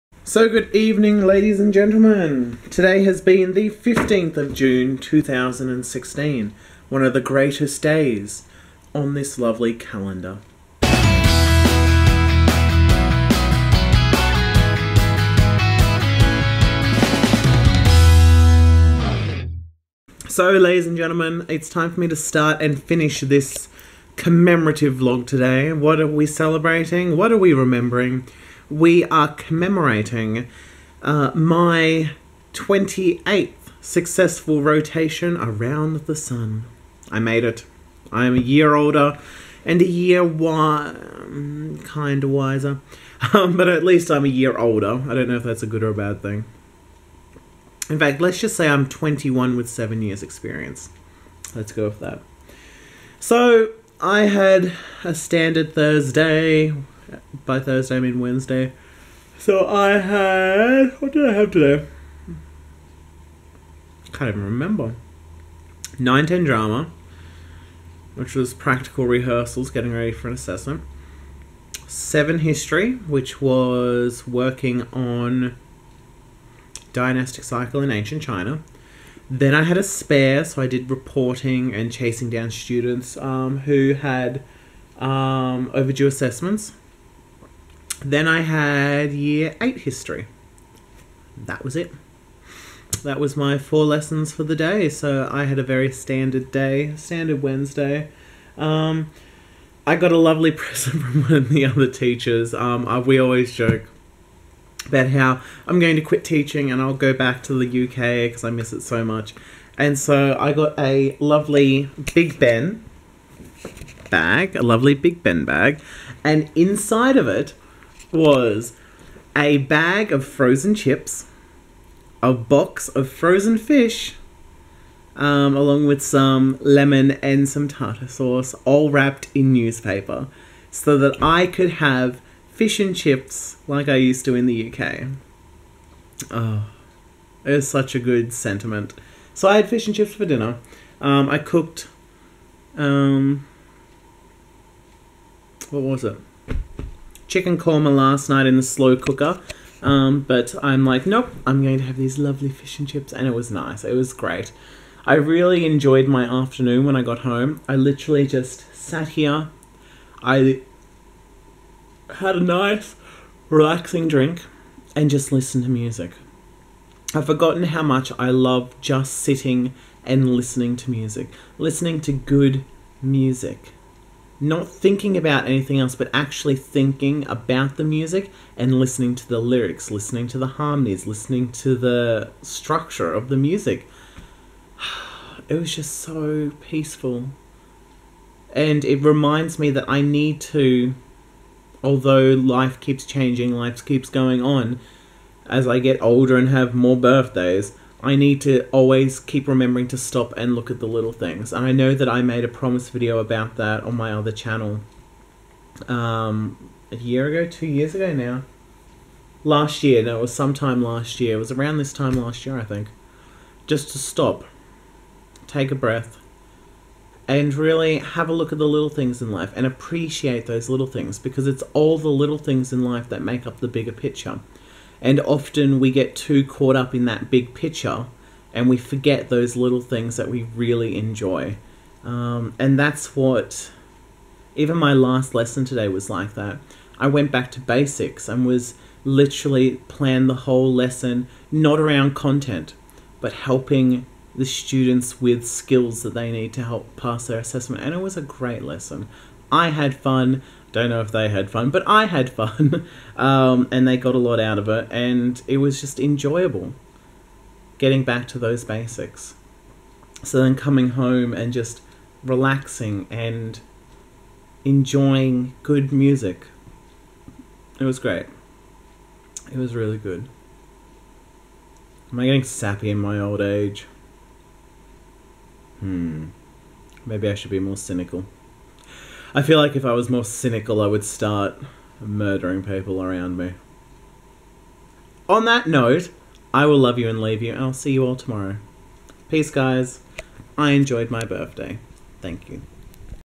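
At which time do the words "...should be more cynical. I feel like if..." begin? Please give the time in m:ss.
4:37.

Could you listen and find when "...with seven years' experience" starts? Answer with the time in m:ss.
0:49.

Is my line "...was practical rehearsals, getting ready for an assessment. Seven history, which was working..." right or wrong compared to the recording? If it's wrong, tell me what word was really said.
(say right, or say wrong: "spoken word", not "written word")
right.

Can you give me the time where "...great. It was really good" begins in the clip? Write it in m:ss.
4:27.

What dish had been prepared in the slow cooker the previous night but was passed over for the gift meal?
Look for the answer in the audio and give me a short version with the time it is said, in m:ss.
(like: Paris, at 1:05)
Chicken korma, at 2:27.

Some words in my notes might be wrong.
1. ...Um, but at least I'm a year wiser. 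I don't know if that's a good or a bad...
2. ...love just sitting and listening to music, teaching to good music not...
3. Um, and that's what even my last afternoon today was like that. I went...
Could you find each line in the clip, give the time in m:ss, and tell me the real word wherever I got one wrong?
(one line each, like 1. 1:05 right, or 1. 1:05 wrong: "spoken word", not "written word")
1. 0:43 wrong: "older", not "wiser"
2. 2:48 wrong: "listening", not "teaching"
3. 3:52 wrong: "lesson", not "afternoon".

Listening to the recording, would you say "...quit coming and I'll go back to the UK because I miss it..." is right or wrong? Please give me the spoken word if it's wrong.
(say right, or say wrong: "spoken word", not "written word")
wrong: "teaching", not "coming".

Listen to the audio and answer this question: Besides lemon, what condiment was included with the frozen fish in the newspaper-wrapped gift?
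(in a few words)
Tartar sauce.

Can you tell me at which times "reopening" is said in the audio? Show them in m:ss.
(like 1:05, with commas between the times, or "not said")
not said.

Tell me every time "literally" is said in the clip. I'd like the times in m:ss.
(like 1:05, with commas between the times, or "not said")
2:37, 3:59.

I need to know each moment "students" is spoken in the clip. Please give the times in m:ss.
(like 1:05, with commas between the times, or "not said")
1:22, 4:04.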